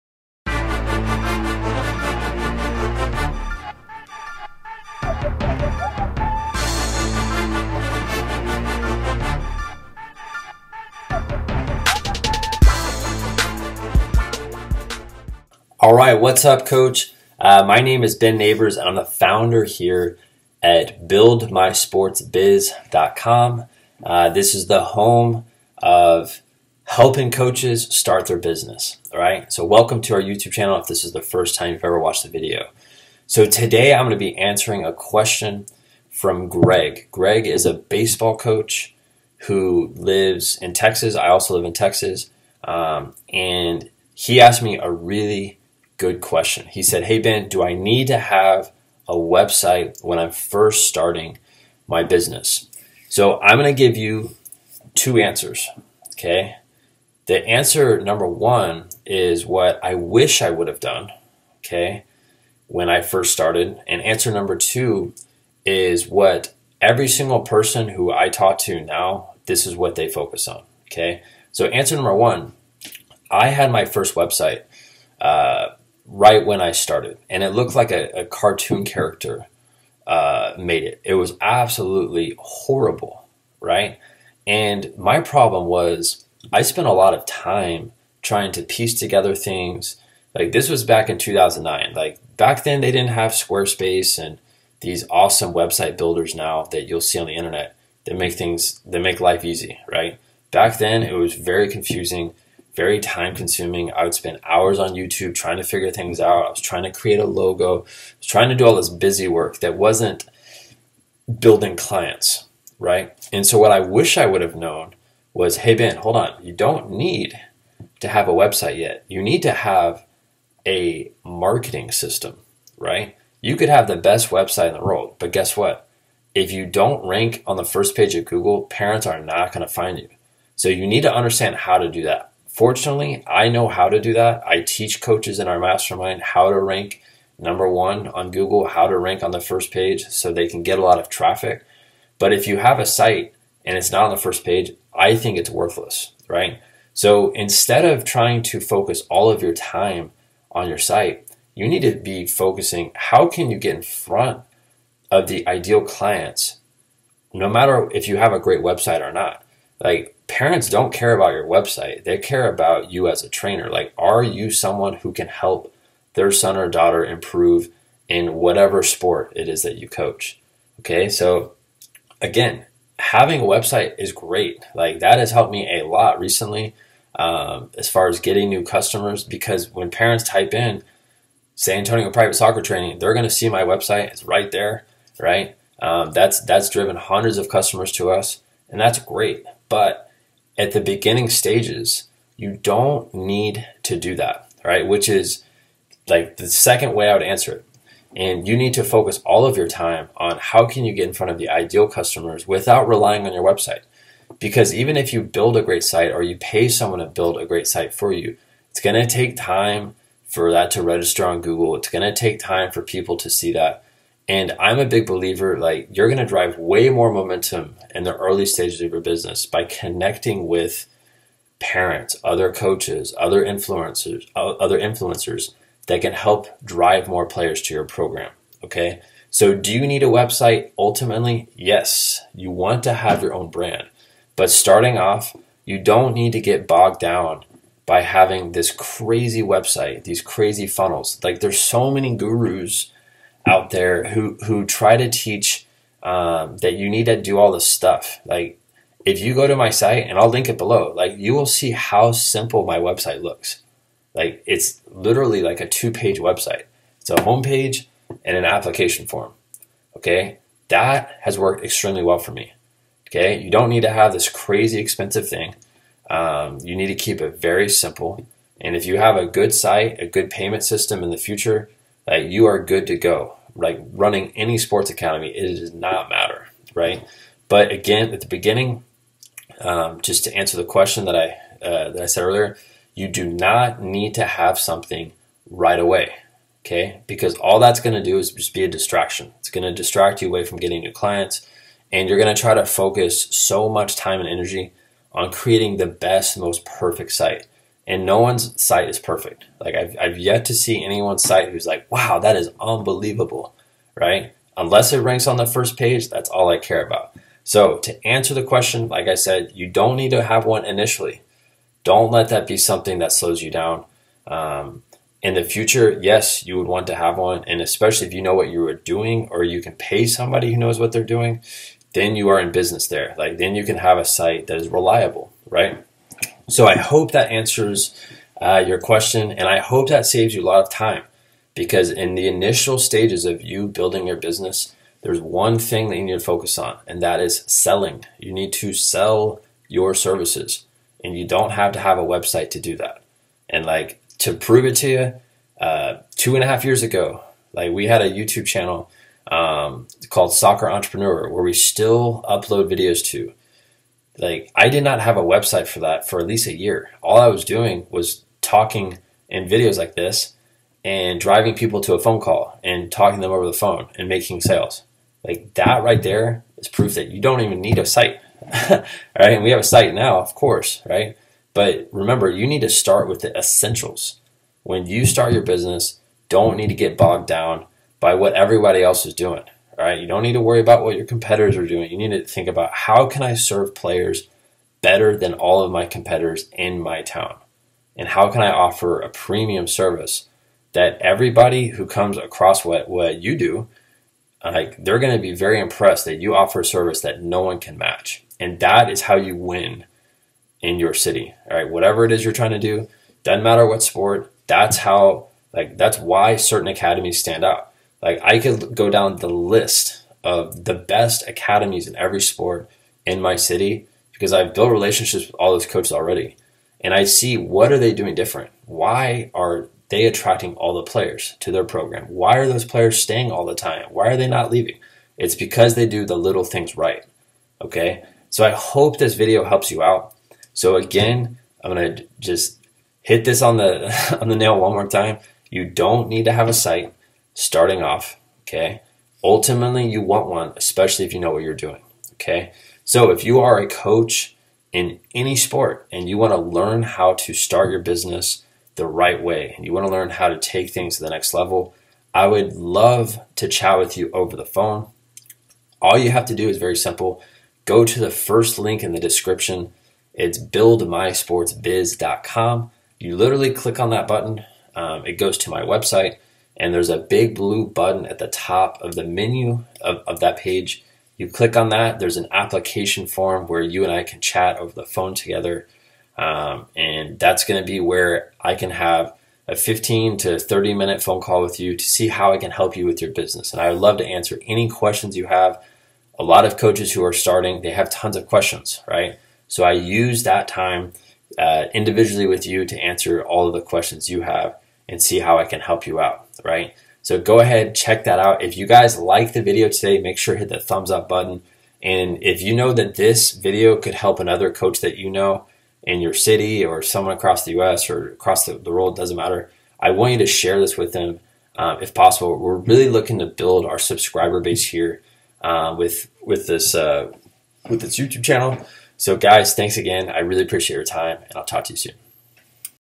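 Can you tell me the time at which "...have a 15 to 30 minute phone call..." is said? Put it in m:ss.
7:58.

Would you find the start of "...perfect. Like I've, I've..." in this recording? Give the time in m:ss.
4:58.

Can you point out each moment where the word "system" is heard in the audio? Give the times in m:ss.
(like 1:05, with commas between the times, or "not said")
2:01, 4:30.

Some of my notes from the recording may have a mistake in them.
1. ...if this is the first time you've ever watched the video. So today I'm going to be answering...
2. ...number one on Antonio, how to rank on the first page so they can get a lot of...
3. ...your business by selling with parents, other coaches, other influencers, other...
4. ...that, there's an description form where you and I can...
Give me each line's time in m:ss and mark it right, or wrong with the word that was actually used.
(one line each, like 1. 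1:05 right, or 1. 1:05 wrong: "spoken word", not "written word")
1. 0:30 right
2. 2:17 wrong: "Google", not "Antonio"
3. 3:38 wrong: "connecting", not "selling"
4. 7:51 wrong: "application", not "description".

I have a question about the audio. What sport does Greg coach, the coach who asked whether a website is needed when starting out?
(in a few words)
Baseball.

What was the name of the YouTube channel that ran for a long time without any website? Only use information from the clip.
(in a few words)
Soccer Entrepreneur.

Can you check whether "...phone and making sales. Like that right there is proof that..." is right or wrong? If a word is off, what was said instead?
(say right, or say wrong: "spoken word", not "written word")
right.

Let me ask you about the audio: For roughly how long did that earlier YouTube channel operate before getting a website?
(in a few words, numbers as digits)
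At least a year.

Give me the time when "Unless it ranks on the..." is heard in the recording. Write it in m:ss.
5:04.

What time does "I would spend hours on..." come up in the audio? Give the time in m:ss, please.
1:43.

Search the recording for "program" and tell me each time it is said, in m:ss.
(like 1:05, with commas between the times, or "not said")
3:47, 7:01.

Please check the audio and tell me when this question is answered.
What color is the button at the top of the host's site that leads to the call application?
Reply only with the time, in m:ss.
7:47.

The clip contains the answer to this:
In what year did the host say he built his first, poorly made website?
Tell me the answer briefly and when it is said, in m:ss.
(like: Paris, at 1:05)
2009, at 1:31.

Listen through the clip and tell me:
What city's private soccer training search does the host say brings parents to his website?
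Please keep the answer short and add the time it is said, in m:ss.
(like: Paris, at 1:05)
San Antonio, at 3:01.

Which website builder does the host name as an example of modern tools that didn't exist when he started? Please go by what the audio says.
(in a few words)
Squarespace.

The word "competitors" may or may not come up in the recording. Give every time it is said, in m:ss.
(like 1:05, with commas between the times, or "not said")
6:21, 6:25.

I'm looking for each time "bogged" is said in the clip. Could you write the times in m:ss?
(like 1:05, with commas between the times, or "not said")
3:56, 6:16.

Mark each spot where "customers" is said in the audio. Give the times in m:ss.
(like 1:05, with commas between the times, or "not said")
2:58, 3:07, 3:21.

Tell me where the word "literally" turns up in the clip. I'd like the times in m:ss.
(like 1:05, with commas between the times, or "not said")
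4:14, 7:43.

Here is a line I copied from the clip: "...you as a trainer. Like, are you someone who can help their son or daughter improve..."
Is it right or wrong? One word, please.
right.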